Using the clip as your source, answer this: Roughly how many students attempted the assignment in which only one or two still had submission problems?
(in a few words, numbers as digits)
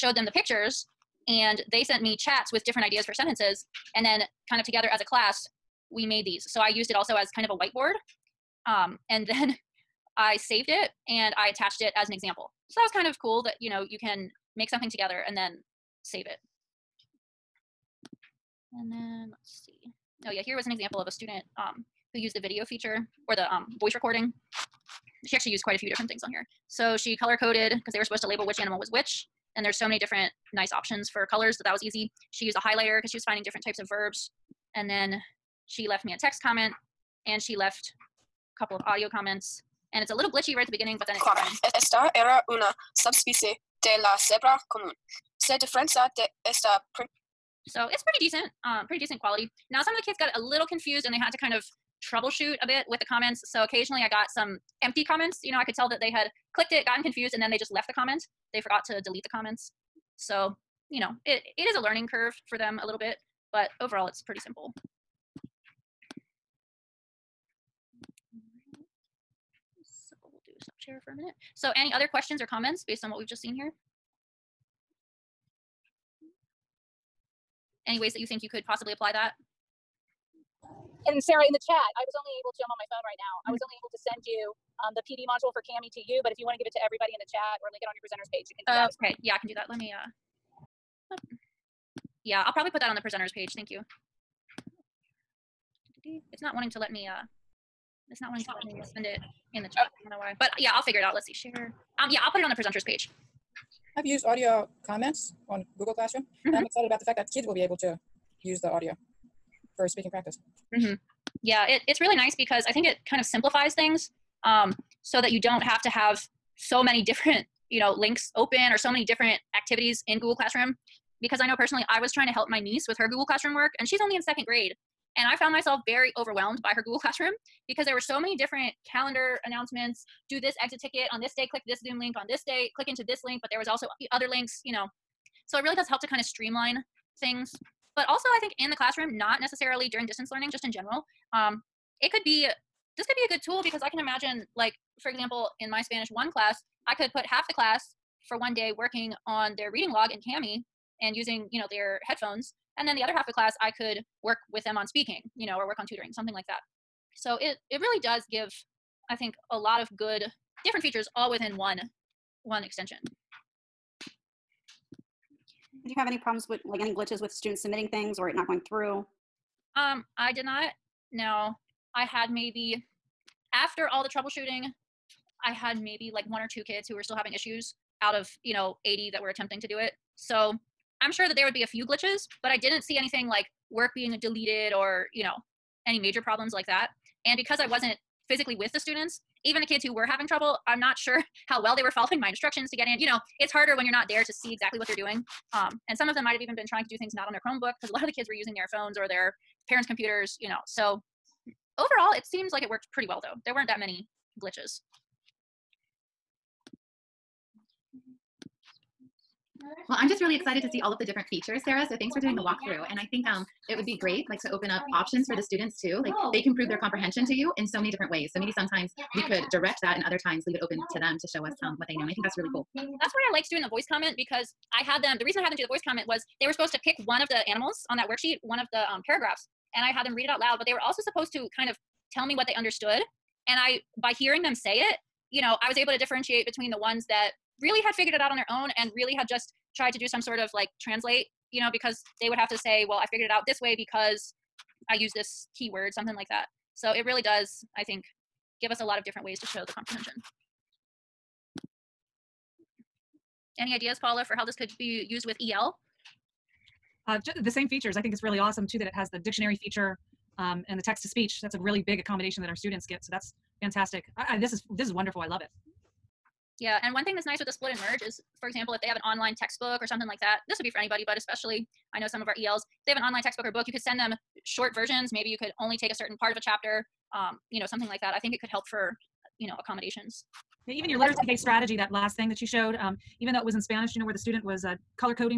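80.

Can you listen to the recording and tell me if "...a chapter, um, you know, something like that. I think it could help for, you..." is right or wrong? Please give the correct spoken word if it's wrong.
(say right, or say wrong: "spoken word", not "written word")
right.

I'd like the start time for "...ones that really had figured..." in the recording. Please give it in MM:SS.
03:56.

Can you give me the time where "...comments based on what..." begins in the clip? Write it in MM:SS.
01:12.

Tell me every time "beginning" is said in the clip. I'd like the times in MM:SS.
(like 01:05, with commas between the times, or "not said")
00:40.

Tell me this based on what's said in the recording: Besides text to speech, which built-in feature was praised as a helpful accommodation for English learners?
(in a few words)
Dictionary.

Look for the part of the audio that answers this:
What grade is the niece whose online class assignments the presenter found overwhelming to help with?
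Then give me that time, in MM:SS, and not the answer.
02:04.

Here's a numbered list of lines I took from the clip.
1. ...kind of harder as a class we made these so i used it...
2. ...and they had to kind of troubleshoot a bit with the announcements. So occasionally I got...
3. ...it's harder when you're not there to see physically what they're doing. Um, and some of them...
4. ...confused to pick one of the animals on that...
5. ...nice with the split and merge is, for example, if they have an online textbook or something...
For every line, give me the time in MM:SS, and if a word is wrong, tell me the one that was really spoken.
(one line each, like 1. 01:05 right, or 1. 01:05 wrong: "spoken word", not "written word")
1. 00:04 wrong: "together", not "harder"
2. 00:51 wrong: "comments", not "announcements"
3. 03:13 wrong: "exactly", not "physically"
4. 03:46 wrong: "supposed", not "confused"
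5. 04:27 right.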